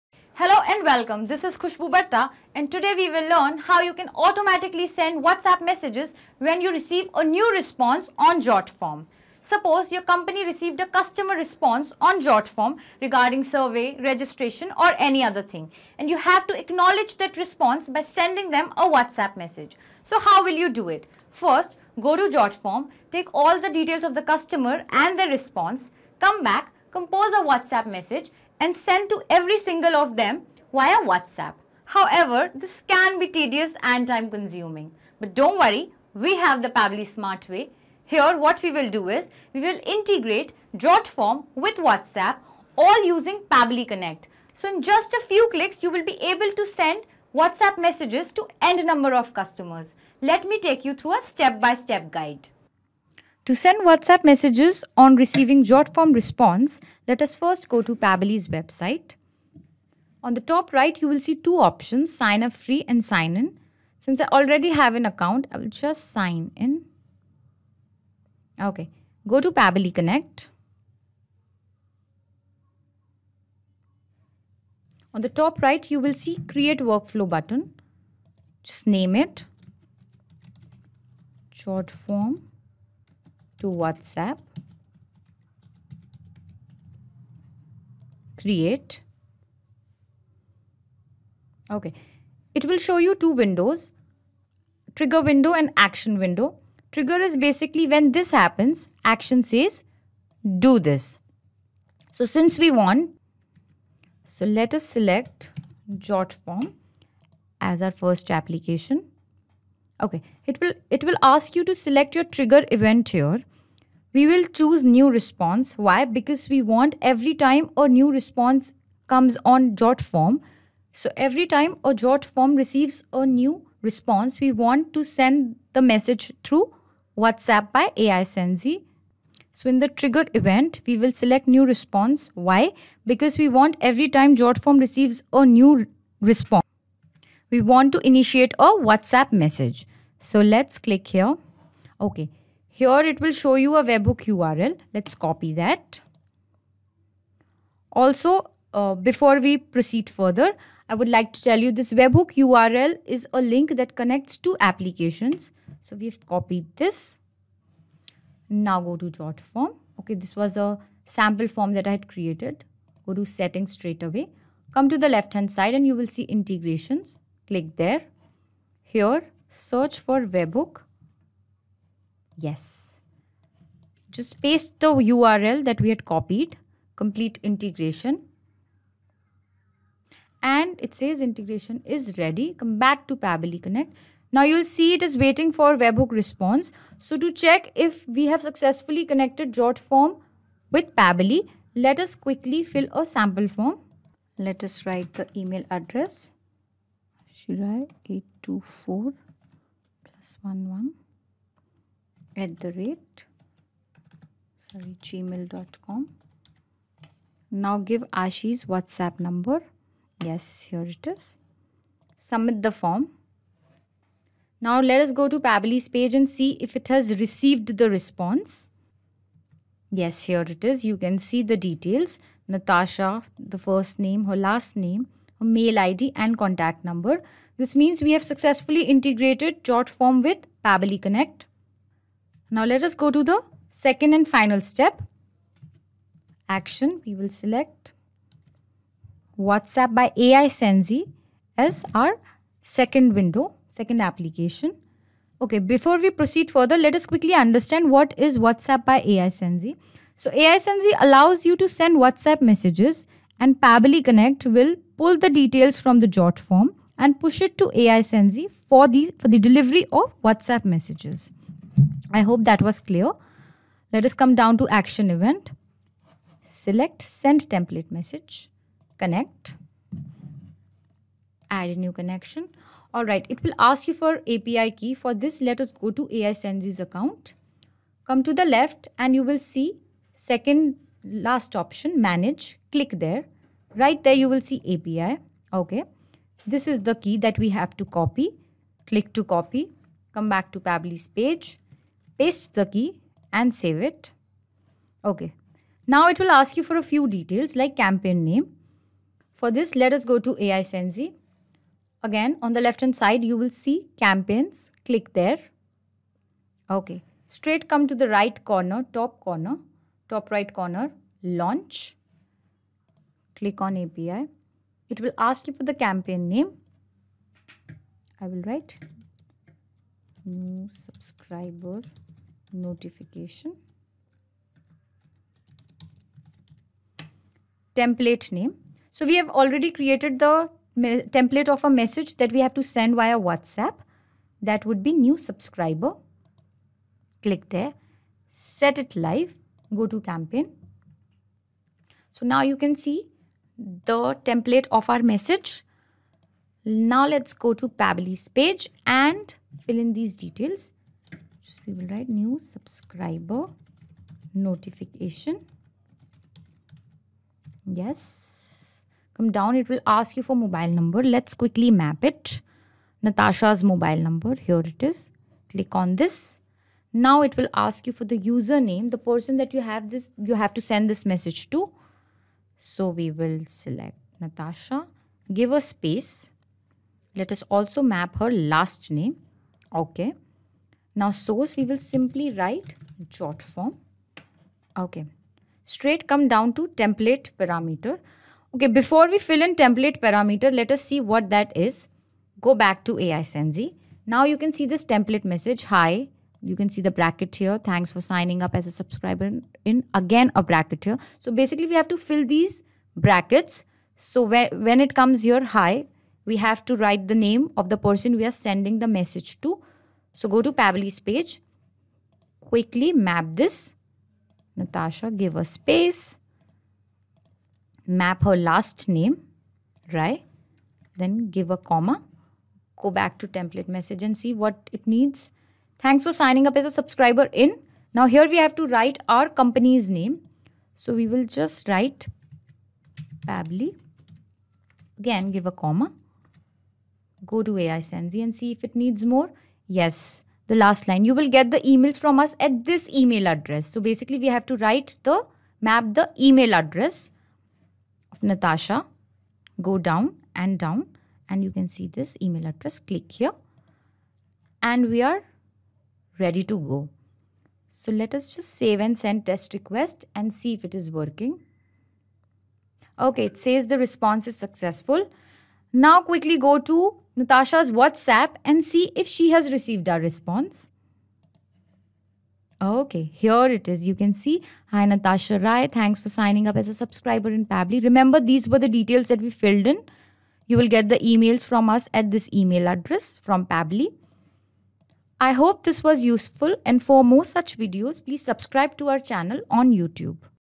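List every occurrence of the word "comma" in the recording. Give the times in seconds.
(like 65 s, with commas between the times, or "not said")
421 s, 435 s.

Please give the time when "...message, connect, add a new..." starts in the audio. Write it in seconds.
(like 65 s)
267 s.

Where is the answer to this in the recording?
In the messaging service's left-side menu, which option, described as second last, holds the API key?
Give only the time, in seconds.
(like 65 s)
281 s.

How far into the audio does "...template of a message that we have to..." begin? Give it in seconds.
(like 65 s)
330 s.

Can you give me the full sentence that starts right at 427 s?
Now here we have to write our company's name.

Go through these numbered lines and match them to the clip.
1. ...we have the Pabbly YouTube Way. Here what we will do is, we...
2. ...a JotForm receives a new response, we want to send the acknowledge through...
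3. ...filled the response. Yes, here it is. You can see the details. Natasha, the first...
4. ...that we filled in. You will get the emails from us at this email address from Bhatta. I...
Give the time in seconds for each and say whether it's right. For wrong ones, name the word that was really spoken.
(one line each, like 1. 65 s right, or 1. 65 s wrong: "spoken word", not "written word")
1. 36 s wrong: "Smart", not "YouTube"
2. 121 s wrong: "message", not "acknowledge"
3. 217 s wrong: "received", not "filled"
4. 479 s wrong: "Pabbly", not "Bhatta".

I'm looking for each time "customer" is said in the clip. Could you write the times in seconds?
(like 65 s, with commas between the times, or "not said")
10 s, 24 s, 49 s.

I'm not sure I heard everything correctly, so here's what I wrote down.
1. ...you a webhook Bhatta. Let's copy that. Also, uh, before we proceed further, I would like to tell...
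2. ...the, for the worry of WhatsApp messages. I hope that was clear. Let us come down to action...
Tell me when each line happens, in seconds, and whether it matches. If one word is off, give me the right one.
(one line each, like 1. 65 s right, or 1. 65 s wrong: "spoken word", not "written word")
1. 143 s wrong: "URL", not "Bhatta"
2. 258 s wrong: "delivery", not "worry".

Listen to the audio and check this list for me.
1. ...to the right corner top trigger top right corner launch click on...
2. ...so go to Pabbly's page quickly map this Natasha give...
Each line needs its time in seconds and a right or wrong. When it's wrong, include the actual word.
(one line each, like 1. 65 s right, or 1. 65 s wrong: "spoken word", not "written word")
1. 307 s wrong: "corner", not "trigger"
2. 410 s right.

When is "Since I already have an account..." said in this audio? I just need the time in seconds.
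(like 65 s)
63 s.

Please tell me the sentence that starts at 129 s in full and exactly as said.
So in the trigger event, we will select new response.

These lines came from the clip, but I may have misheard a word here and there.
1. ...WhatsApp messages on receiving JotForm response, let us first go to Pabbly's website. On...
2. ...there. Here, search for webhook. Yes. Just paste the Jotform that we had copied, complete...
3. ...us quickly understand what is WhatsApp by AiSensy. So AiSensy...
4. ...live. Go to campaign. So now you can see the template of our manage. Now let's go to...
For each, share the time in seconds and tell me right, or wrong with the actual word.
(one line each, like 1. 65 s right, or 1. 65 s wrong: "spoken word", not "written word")
1. 53 s right
2. 167 s wrong: "URL", not "Jotform"
3. 246 s right
4. 338 s wrong: "message", not "manage".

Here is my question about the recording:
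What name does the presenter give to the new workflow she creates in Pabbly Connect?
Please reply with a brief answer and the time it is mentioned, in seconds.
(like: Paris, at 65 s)
JotForm to WhatsApp, at 81 s.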